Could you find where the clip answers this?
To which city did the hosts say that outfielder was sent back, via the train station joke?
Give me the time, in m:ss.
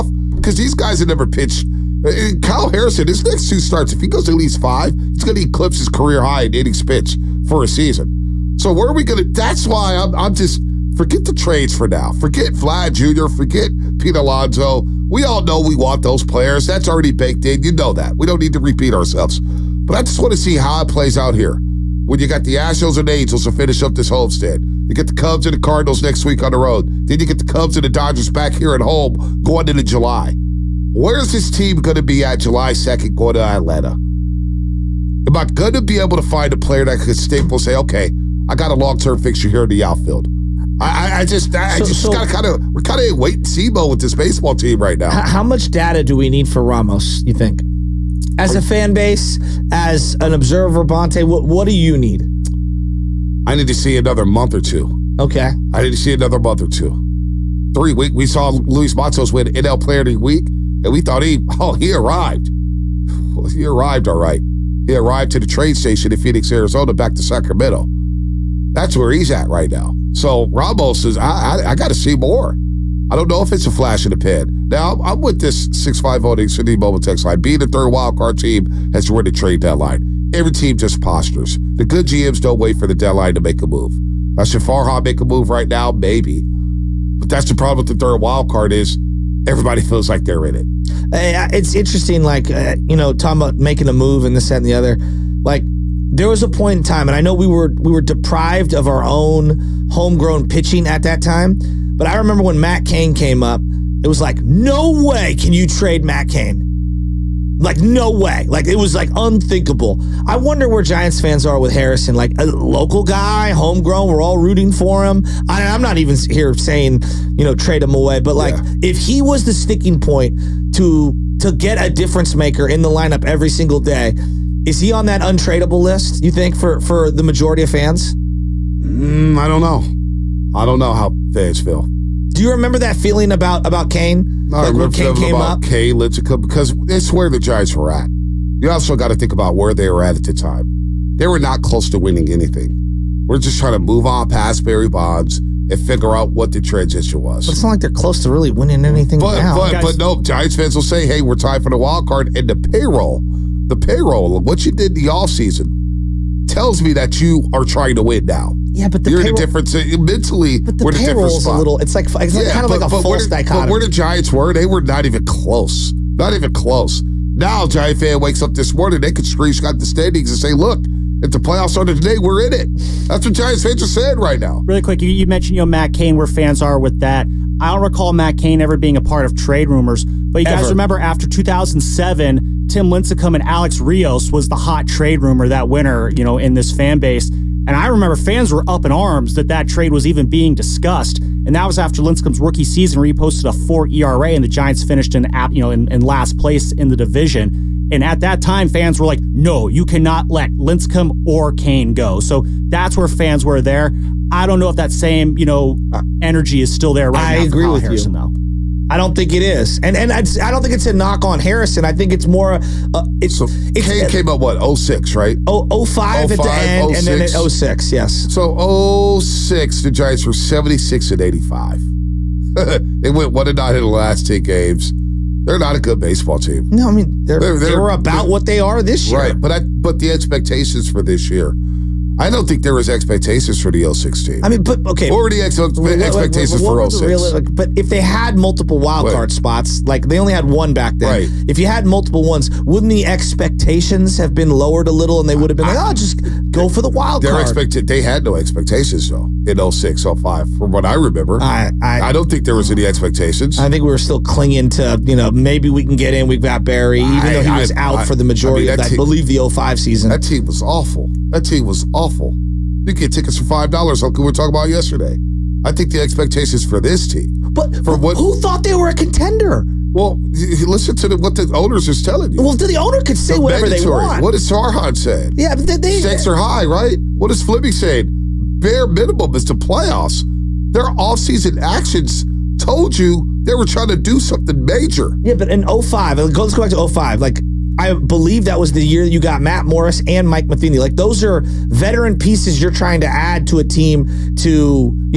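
1:07.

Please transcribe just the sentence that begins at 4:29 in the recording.
Well, listen to the, what the owners is telling you.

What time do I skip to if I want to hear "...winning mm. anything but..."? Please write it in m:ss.
2:28.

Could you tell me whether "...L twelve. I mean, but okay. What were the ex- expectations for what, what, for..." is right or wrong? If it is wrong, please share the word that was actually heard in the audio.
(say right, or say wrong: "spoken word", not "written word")
wrong: "sixteen", not "twelve".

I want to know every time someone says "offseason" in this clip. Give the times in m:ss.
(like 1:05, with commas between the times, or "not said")
2:35, 4:40.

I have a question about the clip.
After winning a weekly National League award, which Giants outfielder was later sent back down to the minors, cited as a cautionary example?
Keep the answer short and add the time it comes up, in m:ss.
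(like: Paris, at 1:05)
Luis Matos, at 0:58.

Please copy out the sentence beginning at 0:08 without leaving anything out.
So where are we going to?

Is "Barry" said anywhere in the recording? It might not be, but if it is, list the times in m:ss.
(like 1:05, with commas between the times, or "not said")
2:24, 4:16.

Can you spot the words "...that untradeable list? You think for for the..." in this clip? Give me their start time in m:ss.
2:05.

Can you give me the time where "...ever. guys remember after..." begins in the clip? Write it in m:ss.
3:00.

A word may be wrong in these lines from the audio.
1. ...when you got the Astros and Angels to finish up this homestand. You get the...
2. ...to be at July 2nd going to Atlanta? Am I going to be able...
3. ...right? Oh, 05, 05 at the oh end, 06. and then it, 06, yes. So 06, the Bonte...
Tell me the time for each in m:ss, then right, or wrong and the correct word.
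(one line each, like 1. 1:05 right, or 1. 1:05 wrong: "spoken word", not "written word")
1. 0:22 right
2. 0:31 right
3. 3:35 wrong: "Giants", not "Bonte".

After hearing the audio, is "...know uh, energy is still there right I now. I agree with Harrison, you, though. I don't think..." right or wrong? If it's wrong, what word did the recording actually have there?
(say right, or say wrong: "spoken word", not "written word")
right.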